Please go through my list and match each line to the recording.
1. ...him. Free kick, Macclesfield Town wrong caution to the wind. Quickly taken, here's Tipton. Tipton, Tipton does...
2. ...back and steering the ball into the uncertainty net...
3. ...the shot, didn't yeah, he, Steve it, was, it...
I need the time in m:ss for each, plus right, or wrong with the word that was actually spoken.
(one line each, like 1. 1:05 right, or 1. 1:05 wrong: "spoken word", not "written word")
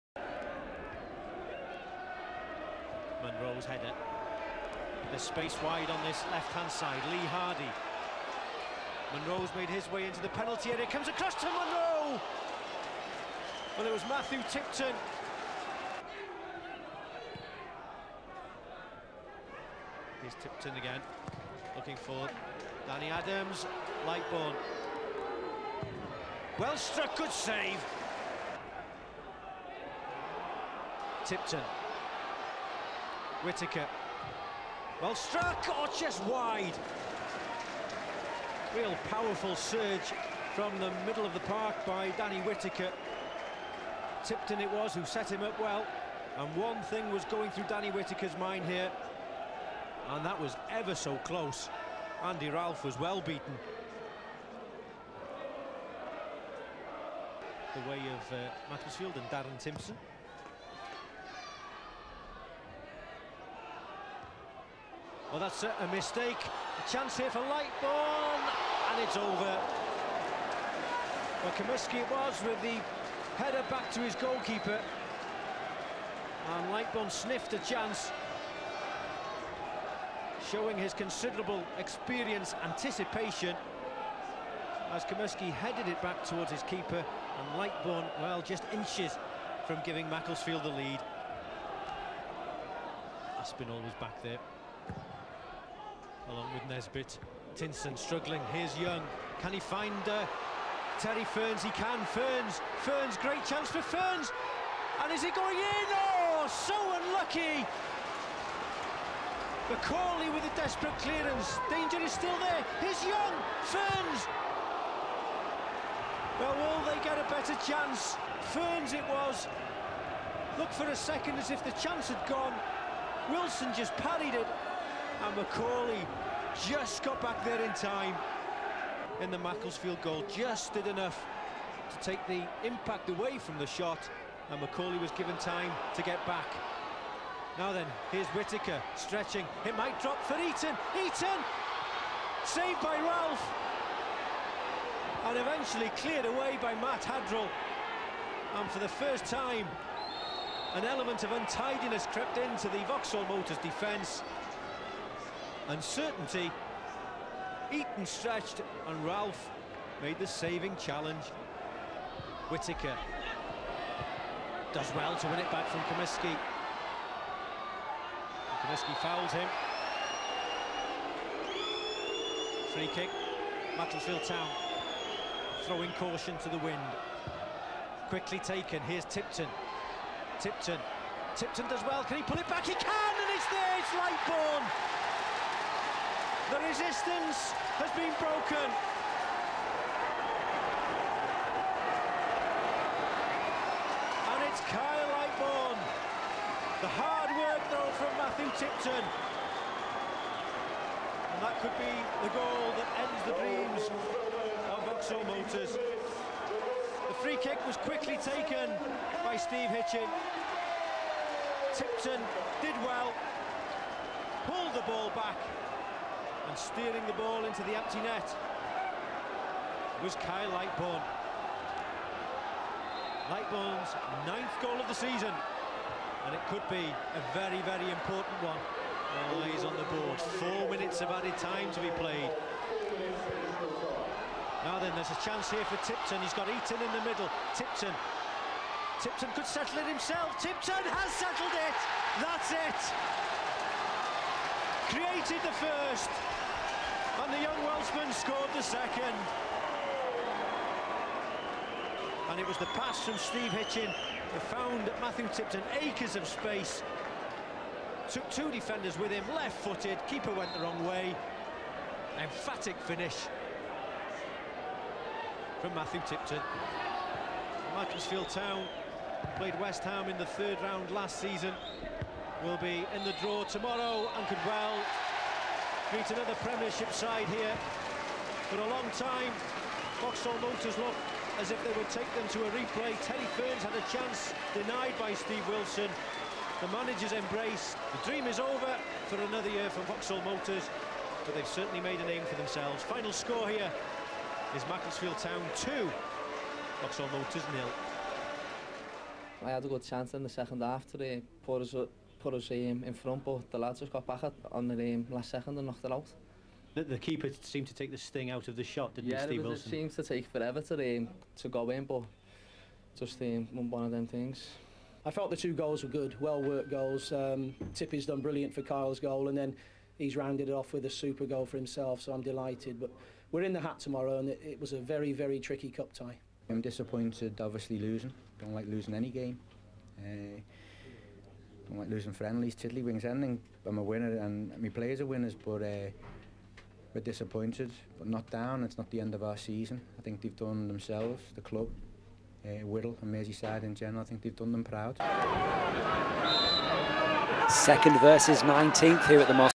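1. 2:49 wrong: "throwing", not "wrong"
2. 3:35 wrong: "empty", not "uncertainty"
3. 5:08 right.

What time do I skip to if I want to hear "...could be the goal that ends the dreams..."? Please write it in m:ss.
3:21.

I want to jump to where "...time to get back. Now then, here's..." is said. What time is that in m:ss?
2:15.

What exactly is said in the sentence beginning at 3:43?
Lightbourne's ninth goal of the season, and it could be a very, very important one.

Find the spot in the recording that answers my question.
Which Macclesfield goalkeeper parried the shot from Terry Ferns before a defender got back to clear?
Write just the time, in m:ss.
4:45.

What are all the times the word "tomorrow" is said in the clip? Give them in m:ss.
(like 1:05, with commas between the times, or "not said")
4:33, 5:23.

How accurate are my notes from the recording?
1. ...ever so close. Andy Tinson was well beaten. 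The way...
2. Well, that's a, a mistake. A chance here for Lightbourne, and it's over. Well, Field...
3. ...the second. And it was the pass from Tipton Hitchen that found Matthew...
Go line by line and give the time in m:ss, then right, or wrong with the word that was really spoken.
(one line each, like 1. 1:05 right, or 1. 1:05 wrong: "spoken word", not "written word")
1. 0:50 wrong: "Ralph", not "Tinson"
2. 1:05 wrong: "Comiskey", not "Field"
3. 4:08 wrong: "Steve", not "Tipton".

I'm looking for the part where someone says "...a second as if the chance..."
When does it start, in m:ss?
2:00.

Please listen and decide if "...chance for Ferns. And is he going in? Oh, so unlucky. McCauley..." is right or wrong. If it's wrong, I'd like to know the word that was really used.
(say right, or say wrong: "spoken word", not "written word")
right.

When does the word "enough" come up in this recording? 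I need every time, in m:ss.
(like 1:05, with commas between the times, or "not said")
2:10.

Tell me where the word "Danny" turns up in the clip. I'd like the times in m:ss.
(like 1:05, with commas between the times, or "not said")
0:22, 0:42, 0:47.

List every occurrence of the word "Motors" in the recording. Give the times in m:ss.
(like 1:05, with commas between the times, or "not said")
2:33, 3:25, 4:40, 4:50, 4:57.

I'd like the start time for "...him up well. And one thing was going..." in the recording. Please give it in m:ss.
0:45.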